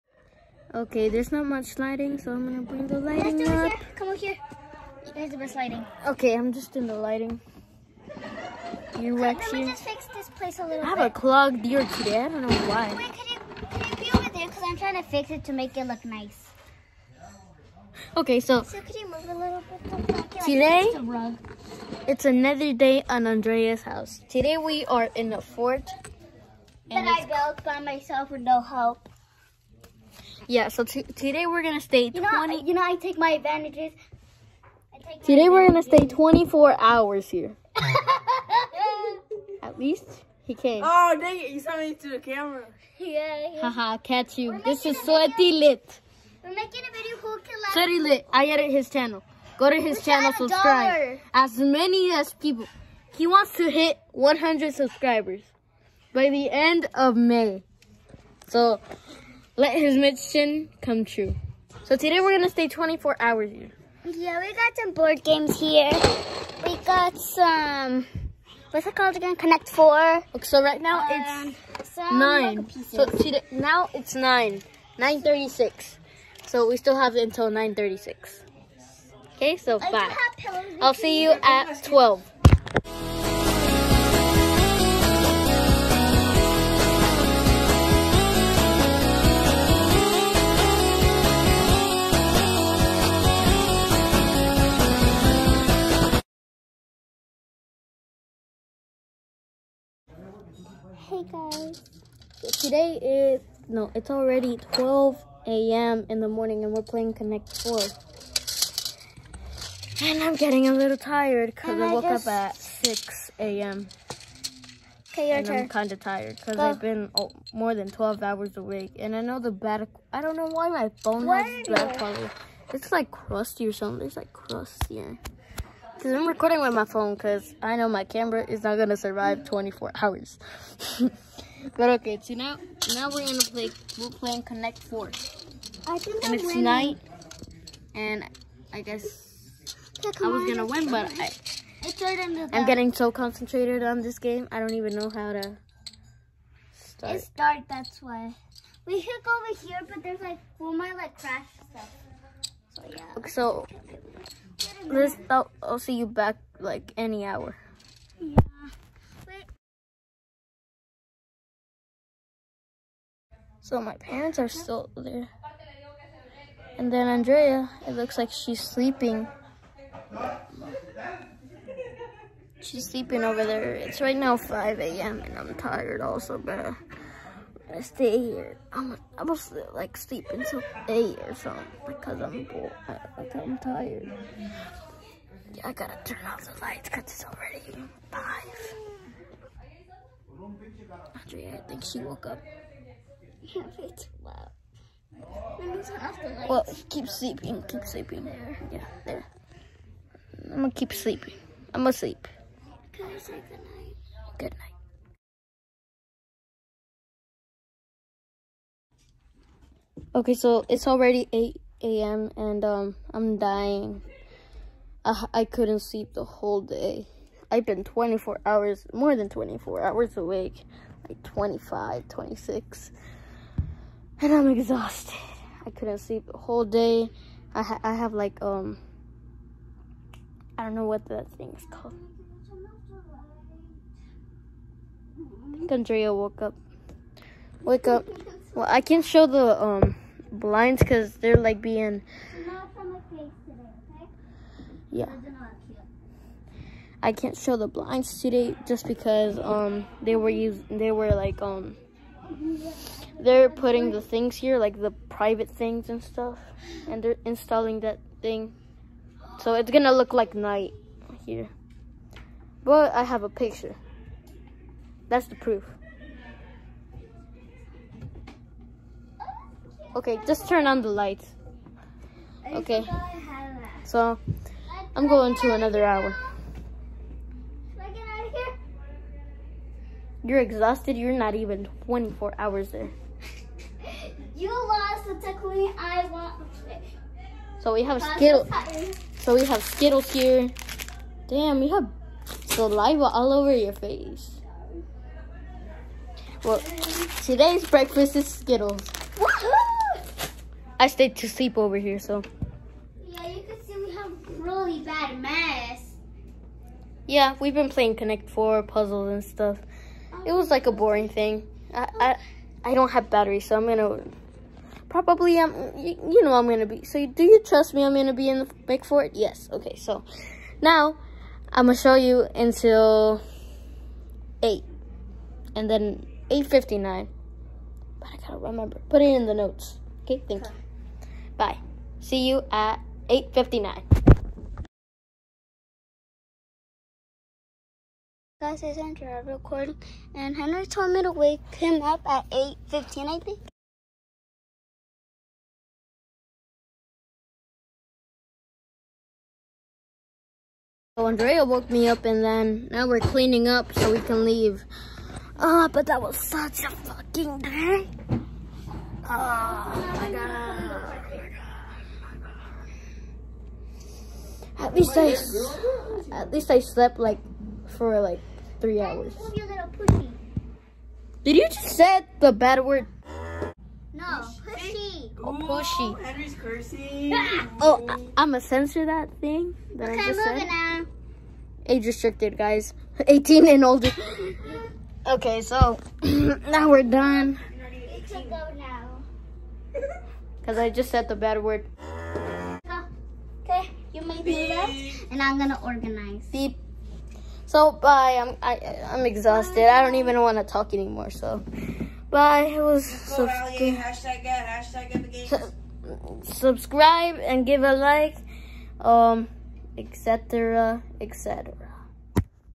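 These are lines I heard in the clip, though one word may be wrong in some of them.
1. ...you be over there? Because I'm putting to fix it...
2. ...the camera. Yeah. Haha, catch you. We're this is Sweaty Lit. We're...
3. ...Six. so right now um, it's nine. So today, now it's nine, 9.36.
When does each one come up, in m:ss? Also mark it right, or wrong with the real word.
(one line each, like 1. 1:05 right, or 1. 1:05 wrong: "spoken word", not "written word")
1. 0:13 wrong: "trying", not "putting"
2. 0:42 right
3. 1:09 wrong: "Four", not "Six".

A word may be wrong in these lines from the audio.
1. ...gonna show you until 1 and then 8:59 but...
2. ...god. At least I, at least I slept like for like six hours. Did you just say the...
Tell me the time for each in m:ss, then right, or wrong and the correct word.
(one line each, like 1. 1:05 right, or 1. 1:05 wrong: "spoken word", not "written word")
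1. 5:21 wrong: "8", not "1"
2. 6:00 wrong: "three", not "six".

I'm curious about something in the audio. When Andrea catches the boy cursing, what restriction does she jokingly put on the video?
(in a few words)
18 and older.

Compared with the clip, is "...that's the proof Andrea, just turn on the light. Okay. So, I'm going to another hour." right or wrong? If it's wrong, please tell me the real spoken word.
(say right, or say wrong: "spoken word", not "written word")
wrong: "Okay", not "Andrea".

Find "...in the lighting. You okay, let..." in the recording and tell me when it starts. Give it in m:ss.
0:06.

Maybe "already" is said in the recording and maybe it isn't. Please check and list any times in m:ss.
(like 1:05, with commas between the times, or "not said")
1:44, 3:07, 3:30.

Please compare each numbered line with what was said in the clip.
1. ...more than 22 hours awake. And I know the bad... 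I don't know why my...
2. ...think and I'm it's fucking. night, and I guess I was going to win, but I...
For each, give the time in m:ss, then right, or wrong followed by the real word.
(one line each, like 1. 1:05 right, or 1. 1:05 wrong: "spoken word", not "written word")
1. 1:57 wrong: "12", not "22"
2. 2:15 wrong: "winning", not "fucking".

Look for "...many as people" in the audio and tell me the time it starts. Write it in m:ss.
0:51.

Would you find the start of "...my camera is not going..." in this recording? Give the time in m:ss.
2:07.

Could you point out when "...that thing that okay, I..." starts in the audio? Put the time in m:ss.
6:18.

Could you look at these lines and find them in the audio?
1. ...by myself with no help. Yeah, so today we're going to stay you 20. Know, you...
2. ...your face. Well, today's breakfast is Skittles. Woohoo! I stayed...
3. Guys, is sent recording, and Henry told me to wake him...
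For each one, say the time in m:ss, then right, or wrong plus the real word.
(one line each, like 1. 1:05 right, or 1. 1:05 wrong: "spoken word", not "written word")
1. 0:27 right
2. 4:53 right
3. 5:38 right.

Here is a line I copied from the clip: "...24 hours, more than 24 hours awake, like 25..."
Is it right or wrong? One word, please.
right.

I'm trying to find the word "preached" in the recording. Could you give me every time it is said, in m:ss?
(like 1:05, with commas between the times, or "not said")
not said.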